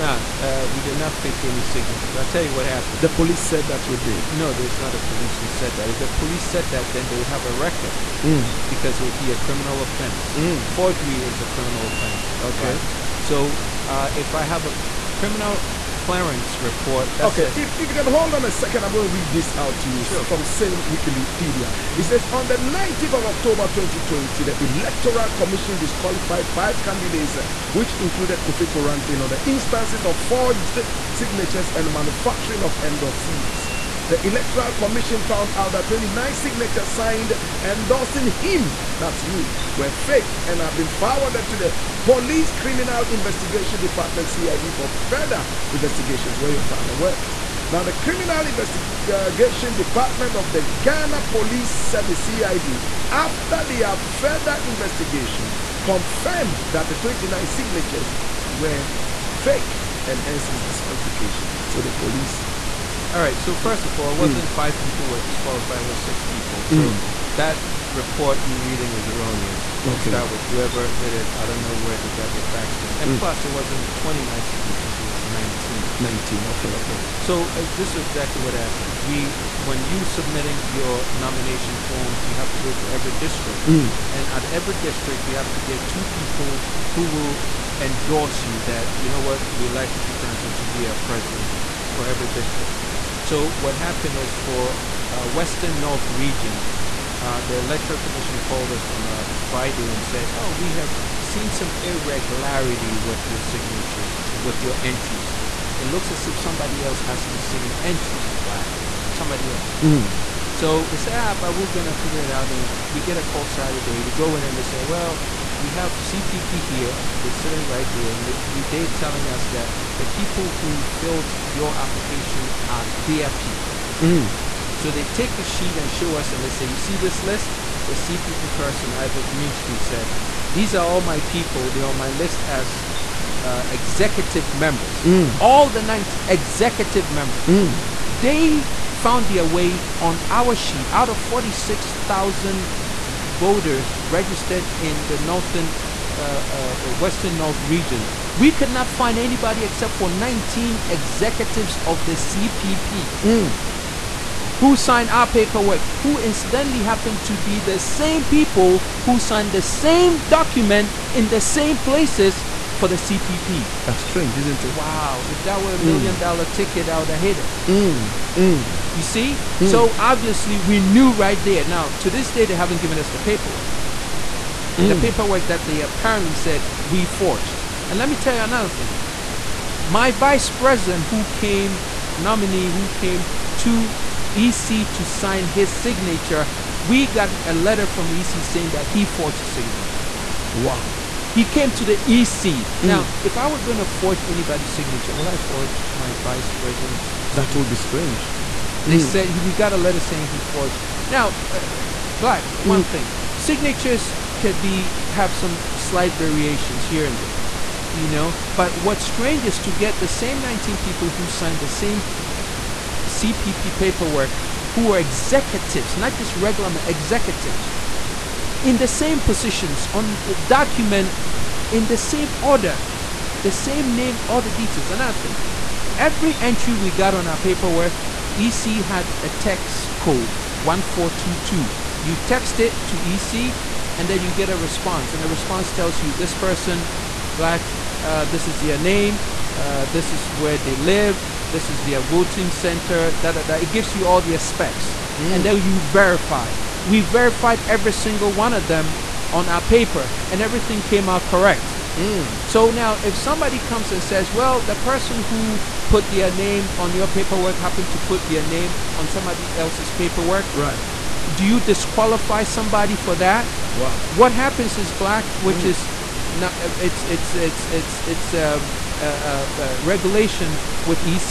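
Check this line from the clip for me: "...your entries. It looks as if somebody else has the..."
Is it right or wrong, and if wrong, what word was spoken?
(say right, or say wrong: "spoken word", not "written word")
right.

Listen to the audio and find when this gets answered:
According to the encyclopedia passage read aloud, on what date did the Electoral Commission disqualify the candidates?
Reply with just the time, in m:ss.
0:22.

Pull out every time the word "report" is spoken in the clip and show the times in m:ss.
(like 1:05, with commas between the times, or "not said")
0:16, 1:07.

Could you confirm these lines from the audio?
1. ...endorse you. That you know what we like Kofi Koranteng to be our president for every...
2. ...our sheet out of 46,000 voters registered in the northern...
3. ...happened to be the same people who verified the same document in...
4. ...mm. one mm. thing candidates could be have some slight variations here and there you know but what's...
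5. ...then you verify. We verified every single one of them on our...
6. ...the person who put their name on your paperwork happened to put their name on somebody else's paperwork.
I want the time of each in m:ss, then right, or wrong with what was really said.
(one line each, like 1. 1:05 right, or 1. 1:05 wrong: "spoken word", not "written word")
1. 1:27 right
2. 2:20 right
3. 2:36 wrong: "signed", not "verified"
4. 3:22 wrong: "signatures", not "candidates"
5. 4:05 right
6. 4:14 right.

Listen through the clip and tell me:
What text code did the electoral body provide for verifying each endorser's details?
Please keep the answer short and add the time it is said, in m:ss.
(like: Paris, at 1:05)
1422, at 3:50.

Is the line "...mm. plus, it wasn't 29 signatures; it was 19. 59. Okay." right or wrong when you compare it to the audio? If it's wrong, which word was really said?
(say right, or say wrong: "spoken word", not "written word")
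wrong: "19", not "59".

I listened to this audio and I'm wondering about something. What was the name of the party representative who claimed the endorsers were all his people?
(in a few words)
Ivor Greenstreet.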